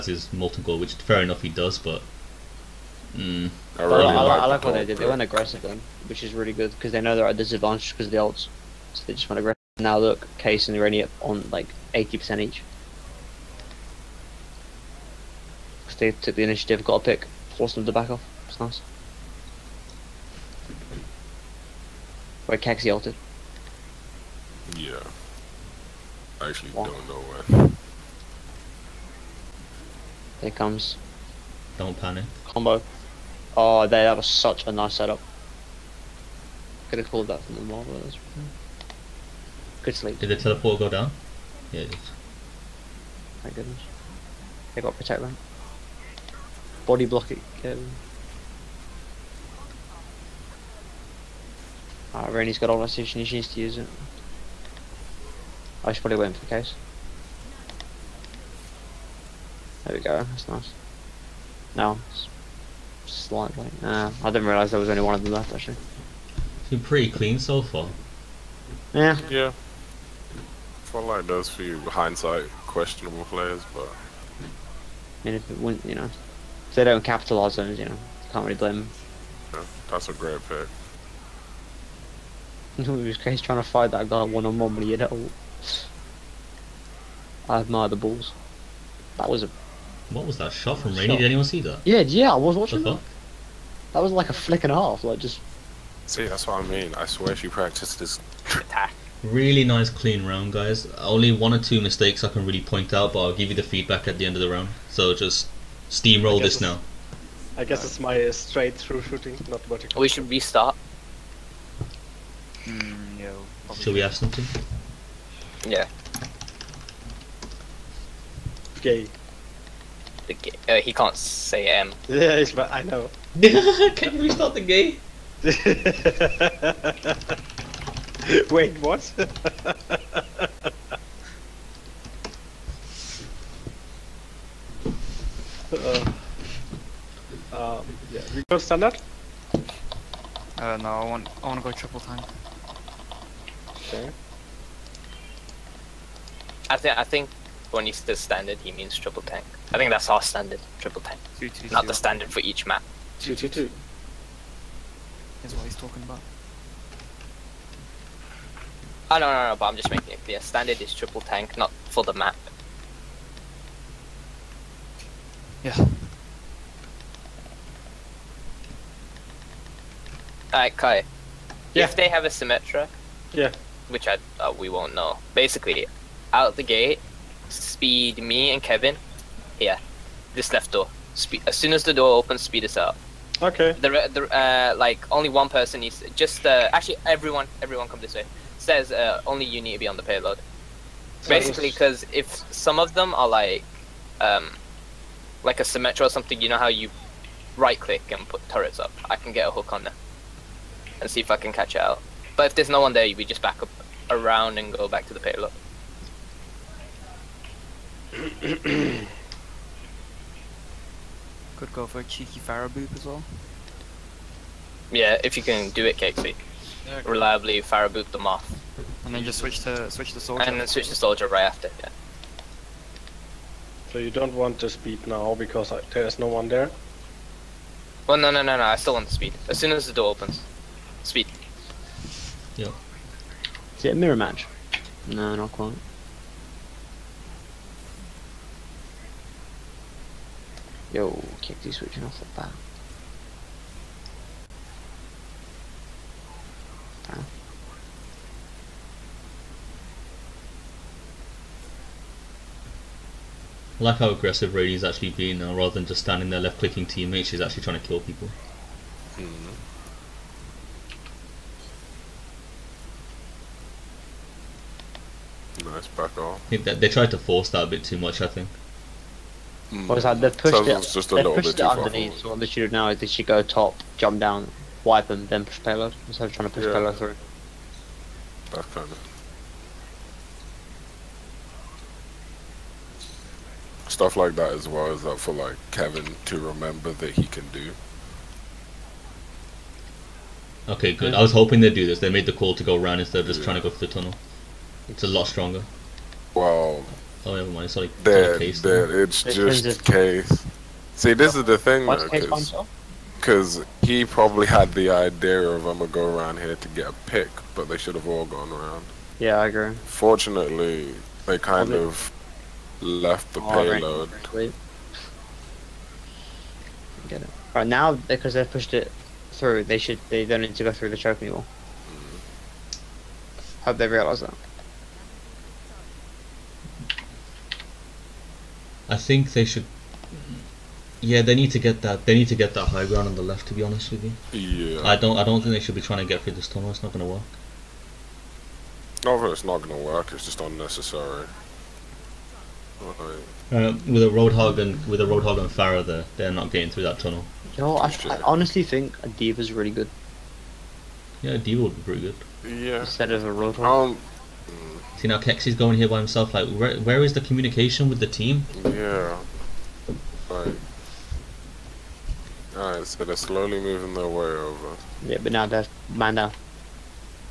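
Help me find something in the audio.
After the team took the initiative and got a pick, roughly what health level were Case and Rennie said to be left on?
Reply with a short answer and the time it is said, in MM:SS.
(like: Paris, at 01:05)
80%, at 00:11.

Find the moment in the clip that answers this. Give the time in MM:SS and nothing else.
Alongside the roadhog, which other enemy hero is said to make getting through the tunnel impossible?
05:45.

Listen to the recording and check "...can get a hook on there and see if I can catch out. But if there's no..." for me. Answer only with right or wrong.
right.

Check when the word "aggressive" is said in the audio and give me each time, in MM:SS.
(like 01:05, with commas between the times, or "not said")
00:05, 00:09, 04:14.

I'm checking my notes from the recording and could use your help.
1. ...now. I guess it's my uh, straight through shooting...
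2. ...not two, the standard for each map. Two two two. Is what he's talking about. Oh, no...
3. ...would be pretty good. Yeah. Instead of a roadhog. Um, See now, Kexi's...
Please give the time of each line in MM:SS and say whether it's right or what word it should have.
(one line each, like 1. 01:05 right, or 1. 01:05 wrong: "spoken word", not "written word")
1. 01:46 right
2. 02:31 right
3. 05:51 right.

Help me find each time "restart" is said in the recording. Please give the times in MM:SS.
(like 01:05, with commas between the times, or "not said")
01:50, 02:04.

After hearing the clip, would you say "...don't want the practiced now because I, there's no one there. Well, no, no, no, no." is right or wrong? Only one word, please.
wrong.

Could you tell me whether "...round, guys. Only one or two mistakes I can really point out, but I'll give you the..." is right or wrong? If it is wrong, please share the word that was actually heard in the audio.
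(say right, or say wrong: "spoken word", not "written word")
right.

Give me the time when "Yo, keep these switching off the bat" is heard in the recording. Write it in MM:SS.
04:00.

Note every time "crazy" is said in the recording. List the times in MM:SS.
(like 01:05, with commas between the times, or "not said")
01:23.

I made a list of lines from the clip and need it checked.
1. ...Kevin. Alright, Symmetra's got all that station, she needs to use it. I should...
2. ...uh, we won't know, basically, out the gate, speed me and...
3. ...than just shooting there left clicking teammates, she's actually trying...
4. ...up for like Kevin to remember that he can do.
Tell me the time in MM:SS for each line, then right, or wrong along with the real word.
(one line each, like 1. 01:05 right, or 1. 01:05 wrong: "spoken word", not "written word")
1. 00:47 wrong: "Rennie", not "Symmetra"
2. 02:54 right
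3. 04:15 wrong: "standing", not "shooting"
4. 04:45 right.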